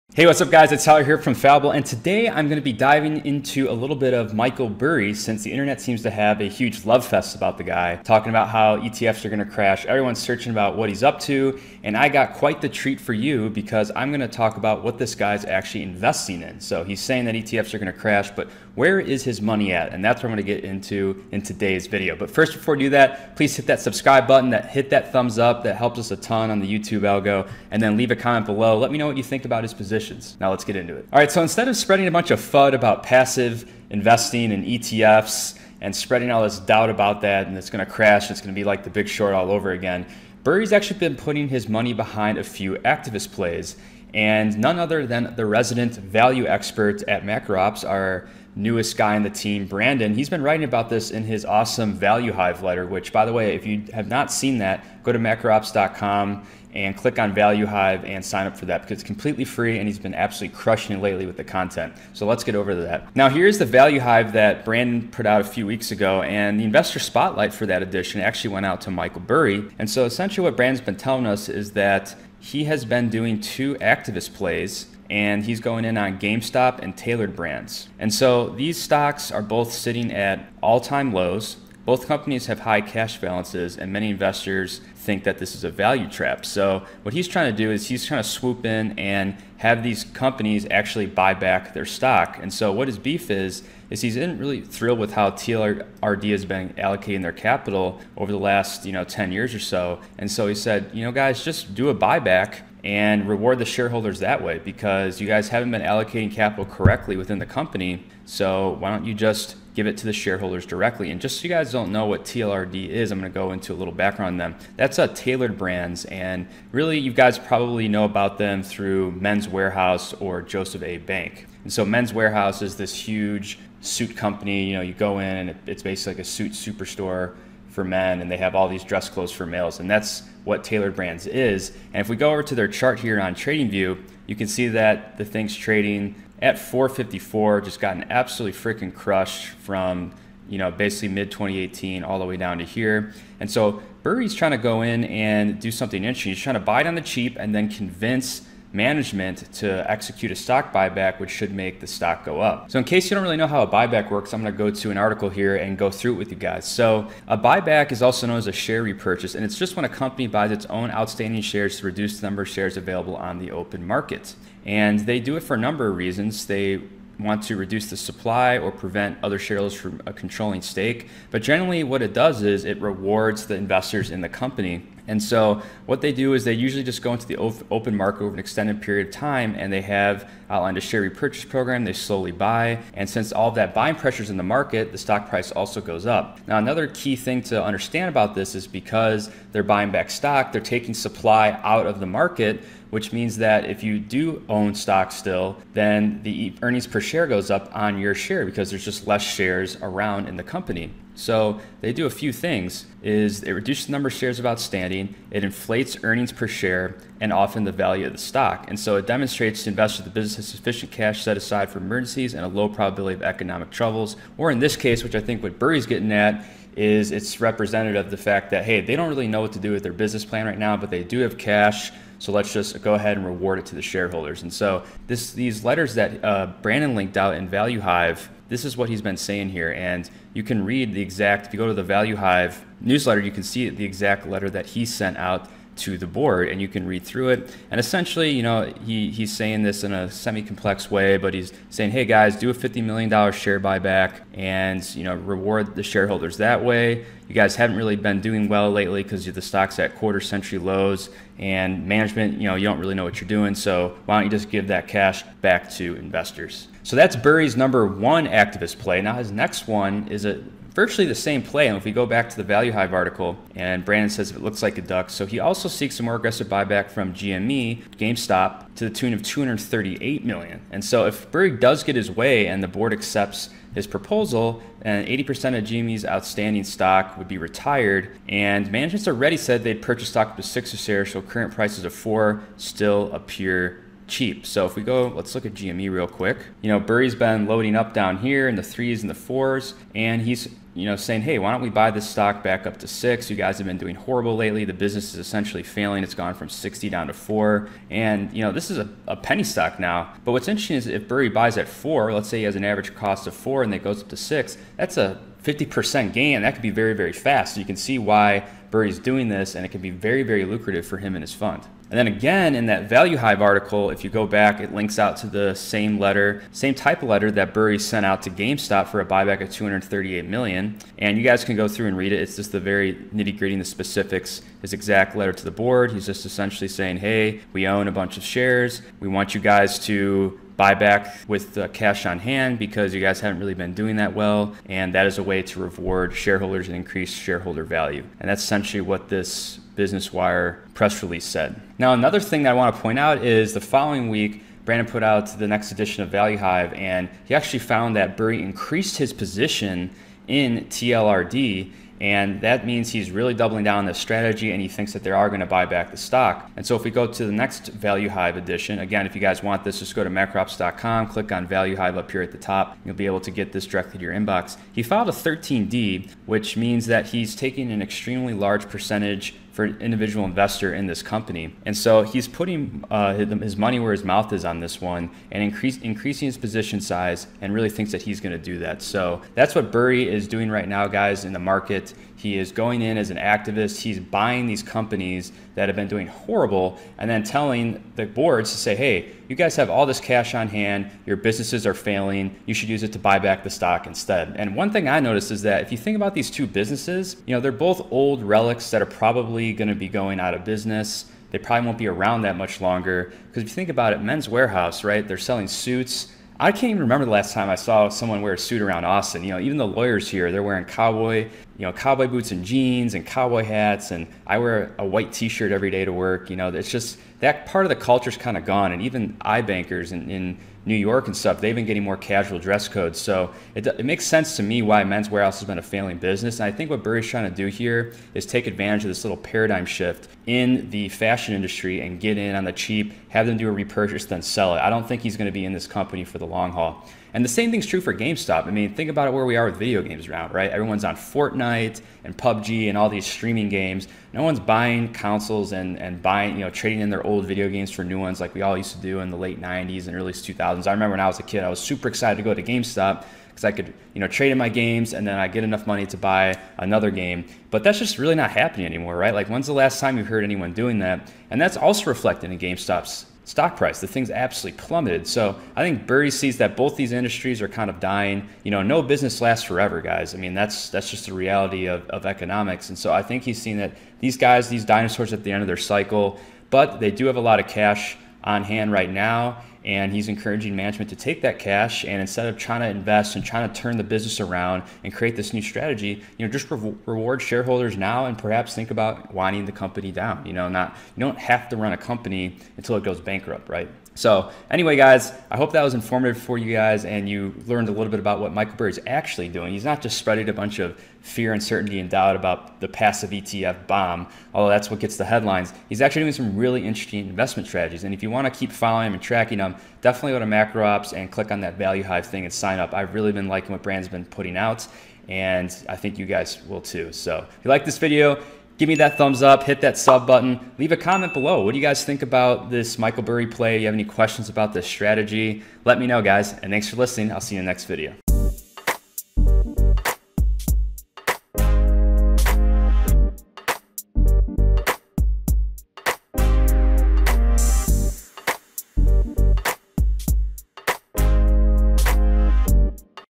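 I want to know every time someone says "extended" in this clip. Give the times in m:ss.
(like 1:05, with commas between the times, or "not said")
2:58.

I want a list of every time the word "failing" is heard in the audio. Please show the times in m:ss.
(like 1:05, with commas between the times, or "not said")
4:55, 6:31, 7:05.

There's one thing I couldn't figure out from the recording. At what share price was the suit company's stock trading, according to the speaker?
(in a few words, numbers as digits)
4.54.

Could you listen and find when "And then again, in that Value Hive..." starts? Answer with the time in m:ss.
5:11.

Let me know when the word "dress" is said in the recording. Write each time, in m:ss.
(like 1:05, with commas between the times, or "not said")
2:08, 7:02.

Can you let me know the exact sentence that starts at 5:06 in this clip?
That could be very, very fast.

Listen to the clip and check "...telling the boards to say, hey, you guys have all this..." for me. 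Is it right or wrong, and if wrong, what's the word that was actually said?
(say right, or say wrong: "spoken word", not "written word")
right.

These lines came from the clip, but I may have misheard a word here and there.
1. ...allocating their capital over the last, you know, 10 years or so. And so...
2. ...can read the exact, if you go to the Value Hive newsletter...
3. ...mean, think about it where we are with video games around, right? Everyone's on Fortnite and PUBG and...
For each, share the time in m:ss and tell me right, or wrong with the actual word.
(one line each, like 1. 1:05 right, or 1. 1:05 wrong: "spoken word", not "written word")
1. 1:36 right
2. 3:50 right
3. 7:18 right.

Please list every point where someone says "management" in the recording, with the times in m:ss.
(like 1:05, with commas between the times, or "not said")
2:28, 4:11, 4:38, 8:00.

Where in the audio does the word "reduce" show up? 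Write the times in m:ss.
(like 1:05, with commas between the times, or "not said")
2:41, 2:47, 3:23.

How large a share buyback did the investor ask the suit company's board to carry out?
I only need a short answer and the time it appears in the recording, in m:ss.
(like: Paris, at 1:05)
$50 million, at 4:02.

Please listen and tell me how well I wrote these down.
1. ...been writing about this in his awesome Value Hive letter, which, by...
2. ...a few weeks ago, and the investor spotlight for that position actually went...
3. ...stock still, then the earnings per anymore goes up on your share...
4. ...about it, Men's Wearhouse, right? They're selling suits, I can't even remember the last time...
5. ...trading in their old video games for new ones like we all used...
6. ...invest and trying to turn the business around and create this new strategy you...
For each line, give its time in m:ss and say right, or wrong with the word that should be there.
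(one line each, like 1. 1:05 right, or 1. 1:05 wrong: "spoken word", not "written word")
1. 0:50 right
2. 1:05 wrong: "edition", not "position"
3. 3:14 wrong: "share", not "anymore"
4. 6:43 right
5. 7:26 right
6. 8:02 right.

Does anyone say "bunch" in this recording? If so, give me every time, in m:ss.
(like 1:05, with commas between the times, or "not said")
0:32, 5:27, 8:20.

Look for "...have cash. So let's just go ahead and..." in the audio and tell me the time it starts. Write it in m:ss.
3:41.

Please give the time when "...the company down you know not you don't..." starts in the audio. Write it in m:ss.
8:09.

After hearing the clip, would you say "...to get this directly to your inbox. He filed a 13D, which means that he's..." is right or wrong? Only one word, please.
right.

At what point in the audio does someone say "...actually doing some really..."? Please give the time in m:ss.
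8:25.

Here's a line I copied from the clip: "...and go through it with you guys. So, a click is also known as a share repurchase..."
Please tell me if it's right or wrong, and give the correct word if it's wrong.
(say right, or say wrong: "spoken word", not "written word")
wrong: "buyback", not "click".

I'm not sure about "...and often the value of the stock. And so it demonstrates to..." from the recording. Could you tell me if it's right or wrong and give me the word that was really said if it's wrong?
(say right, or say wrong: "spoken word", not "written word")
right.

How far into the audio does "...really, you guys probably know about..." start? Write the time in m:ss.
1:56.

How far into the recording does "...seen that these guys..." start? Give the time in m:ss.
7:53.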